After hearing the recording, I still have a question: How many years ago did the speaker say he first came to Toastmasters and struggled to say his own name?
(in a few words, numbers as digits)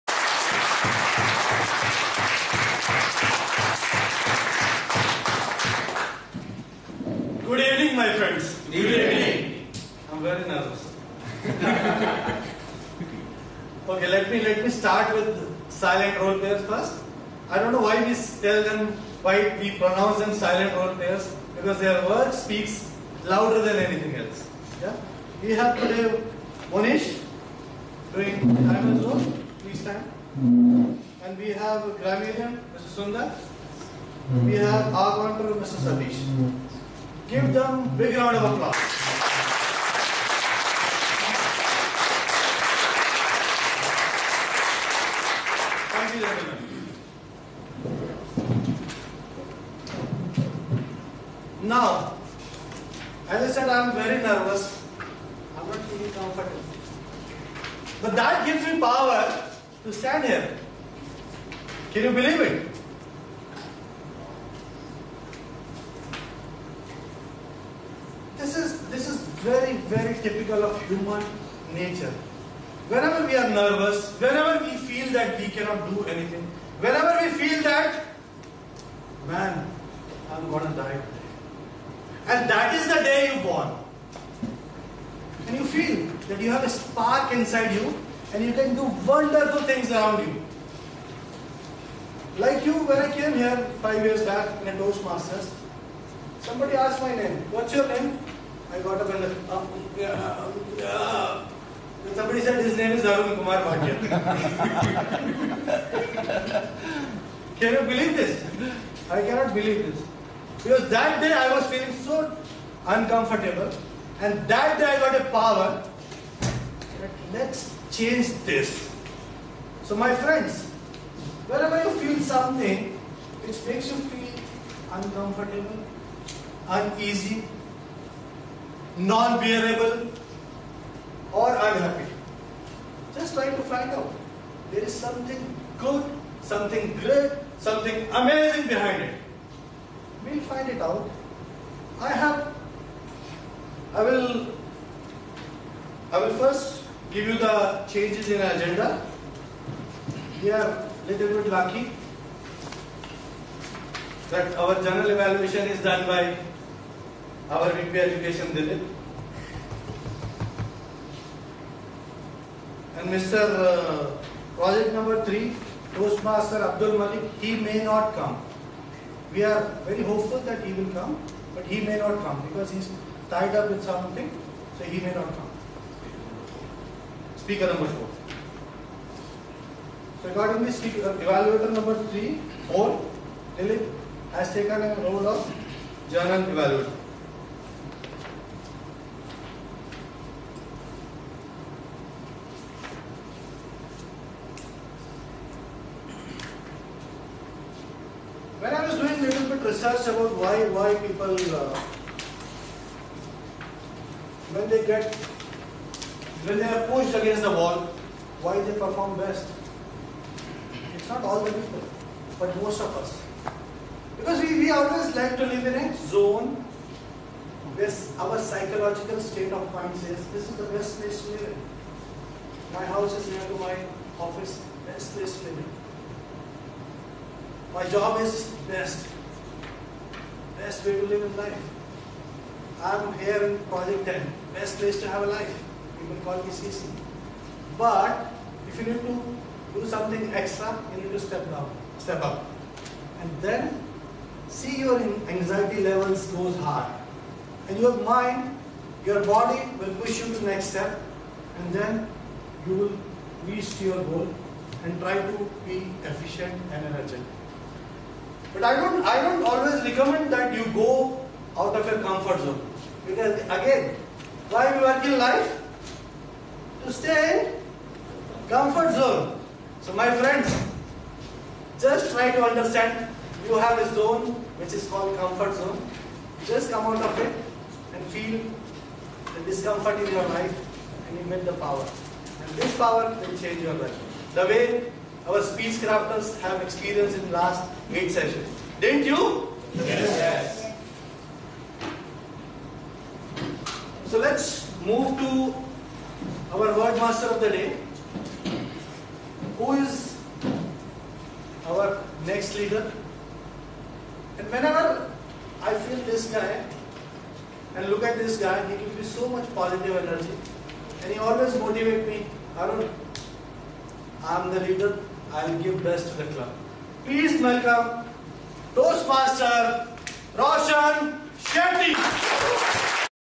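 5.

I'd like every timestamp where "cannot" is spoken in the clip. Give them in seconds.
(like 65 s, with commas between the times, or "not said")
75 s, 109 s.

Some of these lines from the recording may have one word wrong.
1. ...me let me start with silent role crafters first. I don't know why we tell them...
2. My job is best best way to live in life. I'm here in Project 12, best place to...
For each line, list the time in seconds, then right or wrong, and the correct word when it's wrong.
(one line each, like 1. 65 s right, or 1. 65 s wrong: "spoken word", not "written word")
1. 14 s wrong: "players", not "crafters"
2. 227 s wrong: "10", not "12".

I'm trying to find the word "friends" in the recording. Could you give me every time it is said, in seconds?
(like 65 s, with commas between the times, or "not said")
120 s, 270 s.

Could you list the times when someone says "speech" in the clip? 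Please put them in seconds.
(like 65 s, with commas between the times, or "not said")
285 s.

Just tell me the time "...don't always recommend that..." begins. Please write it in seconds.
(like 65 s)
259 s.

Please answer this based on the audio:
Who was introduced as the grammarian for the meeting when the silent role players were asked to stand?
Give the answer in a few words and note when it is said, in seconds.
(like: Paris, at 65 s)
Sundar, at 32 s.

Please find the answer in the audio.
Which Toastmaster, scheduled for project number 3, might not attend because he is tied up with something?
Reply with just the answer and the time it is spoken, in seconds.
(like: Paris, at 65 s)
Abdul Malik, at 166 s.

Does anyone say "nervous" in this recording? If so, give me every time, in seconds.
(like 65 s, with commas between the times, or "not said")
10 s, 54 s, 73 s.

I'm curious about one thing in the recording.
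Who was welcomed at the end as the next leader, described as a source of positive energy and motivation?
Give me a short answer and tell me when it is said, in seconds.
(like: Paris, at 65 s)
Roshan Shetty, at 320 s.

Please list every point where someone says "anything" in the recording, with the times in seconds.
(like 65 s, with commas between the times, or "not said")
23 s, 76 s.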